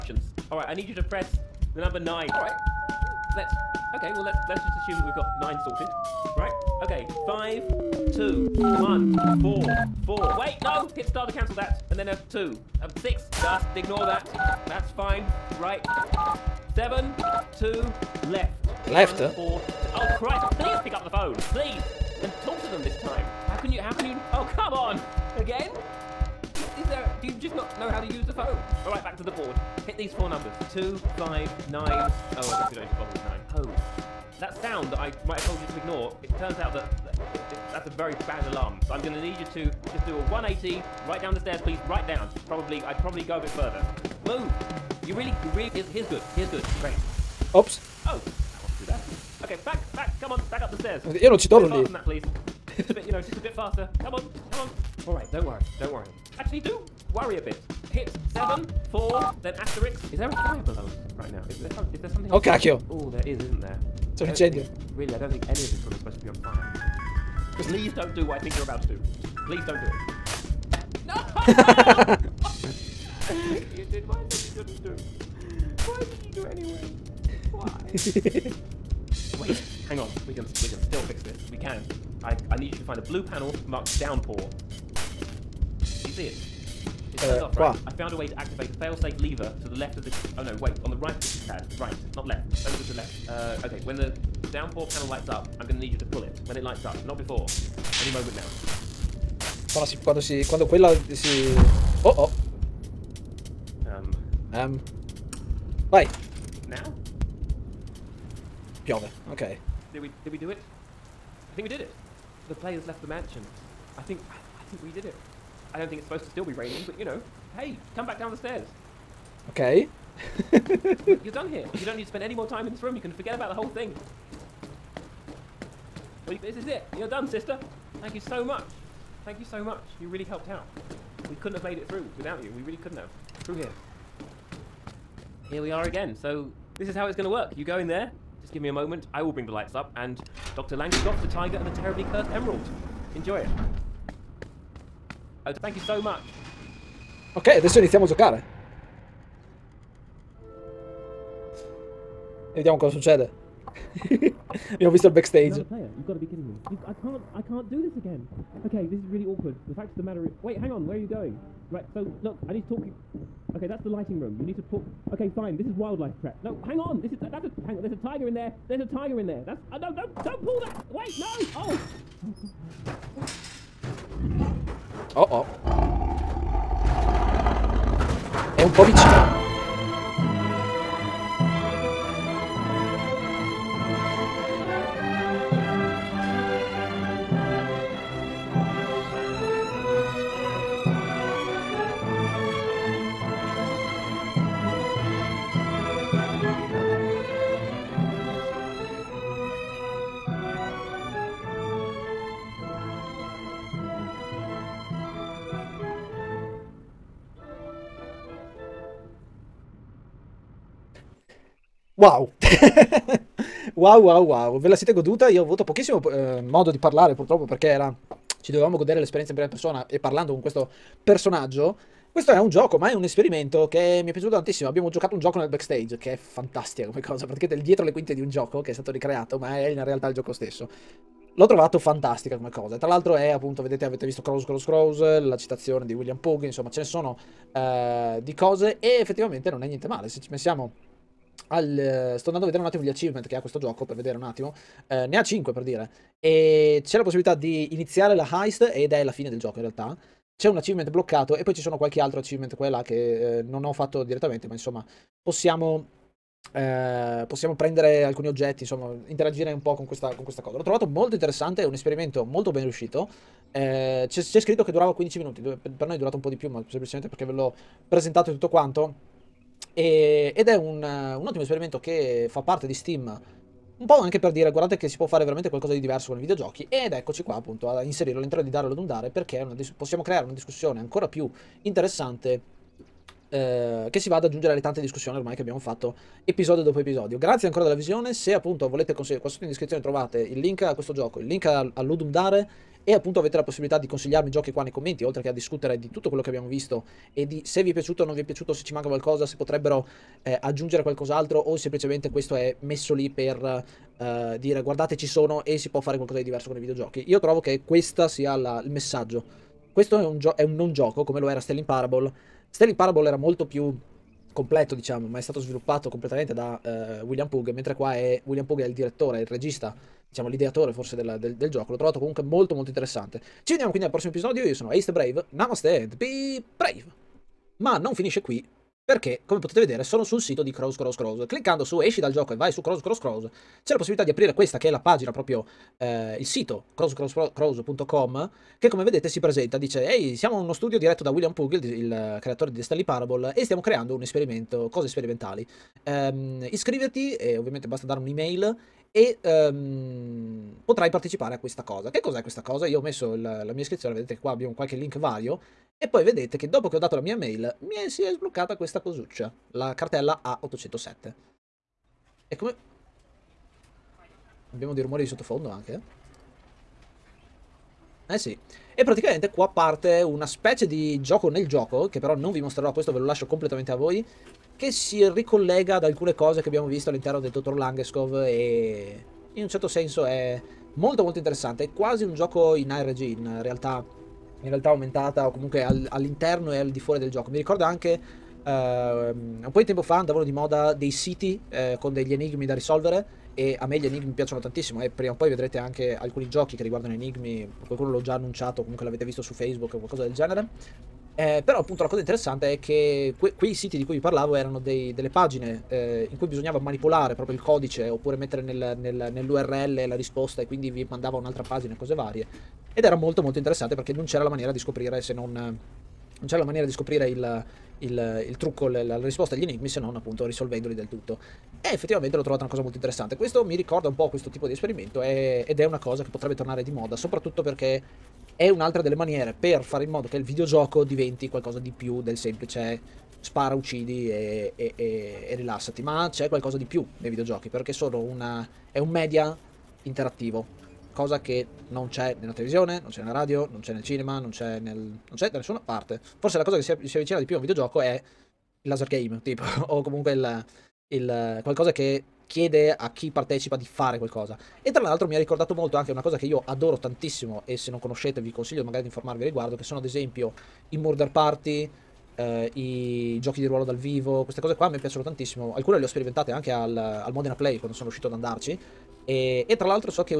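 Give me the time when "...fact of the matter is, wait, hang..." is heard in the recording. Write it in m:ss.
2:39.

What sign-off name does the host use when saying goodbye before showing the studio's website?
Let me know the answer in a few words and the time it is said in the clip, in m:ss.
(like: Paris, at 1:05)
Ace the Brave, at 5:24.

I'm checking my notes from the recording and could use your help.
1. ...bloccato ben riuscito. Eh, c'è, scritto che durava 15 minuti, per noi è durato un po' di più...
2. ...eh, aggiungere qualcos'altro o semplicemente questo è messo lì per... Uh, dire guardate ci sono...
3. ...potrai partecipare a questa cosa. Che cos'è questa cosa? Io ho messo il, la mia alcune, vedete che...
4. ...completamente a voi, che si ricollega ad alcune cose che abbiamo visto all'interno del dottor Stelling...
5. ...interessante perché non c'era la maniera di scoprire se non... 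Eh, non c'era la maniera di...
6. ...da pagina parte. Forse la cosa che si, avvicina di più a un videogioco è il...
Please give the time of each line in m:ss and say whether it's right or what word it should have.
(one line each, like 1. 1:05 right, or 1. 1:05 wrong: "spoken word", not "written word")
1. 4:22 wrong: "molto", not "bloccato"
2. 5:00 right
3. 5:50 wrong: "iscrizione", not "alcune"
4. 6:13 wrong: "Langeskov", not "Stelling"
5. 6:53 right
6. 7:25 wrong: "nessuna", not "pagina".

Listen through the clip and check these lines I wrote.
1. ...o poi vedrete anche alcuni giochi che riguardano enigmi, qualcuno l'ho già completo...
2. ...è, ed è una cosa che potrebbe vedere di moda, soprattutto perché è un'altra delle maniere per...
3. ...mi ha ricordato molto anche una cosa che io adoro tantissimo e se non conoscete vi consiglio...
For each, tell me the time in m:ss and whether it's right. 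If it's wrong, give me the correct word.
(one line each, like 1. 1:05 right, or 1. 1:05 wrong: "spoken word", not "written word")
1. 6:35 wrong: "annunciato", not "completo"
2. 7:05 wrong: "tornare", not "vedere"
3. 7:35 right.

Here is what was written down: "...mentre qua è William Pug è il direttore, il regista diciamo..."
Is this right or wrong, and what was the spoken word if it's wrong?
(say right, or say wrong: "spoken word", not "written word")
right.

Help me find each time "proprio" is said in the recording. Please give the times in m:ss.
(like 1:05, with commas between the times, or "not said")
5:35, 6:47.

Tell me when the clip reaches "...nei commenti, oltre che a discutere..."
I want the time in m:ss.
4:54.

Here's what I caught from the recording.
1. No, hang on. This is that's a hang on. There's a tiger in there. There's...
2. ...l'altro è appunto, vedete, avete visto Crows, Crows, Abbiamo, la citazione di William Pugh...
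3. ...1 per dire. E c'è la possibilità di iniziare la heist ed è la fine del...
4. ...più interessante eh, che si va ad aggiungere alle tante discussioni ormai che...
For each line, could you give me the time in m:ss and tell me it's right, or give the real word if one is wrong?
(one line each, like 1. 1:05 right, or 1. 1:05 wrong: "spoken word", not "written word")
1. 2:46 right
2. 3:52 wrong: "Crows", not "Abbiamo"
3. 4:05 wrong: "5", not "1"
4. 4:41 right.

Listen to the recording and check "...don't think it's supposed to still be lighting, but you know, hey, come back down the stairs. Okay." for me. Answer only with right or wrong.
wrong.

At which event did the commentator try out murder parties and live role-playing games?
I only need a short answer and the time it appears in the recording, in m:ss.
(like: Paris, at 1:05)
Modena Play, at 7:47.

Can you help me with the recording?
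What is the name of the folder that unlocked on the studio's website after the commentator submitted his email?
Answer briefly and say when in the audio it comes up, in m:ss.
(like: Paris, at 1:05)
A807, at 6:00.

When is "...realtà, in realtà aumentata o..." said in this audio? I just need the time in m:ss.
6:23.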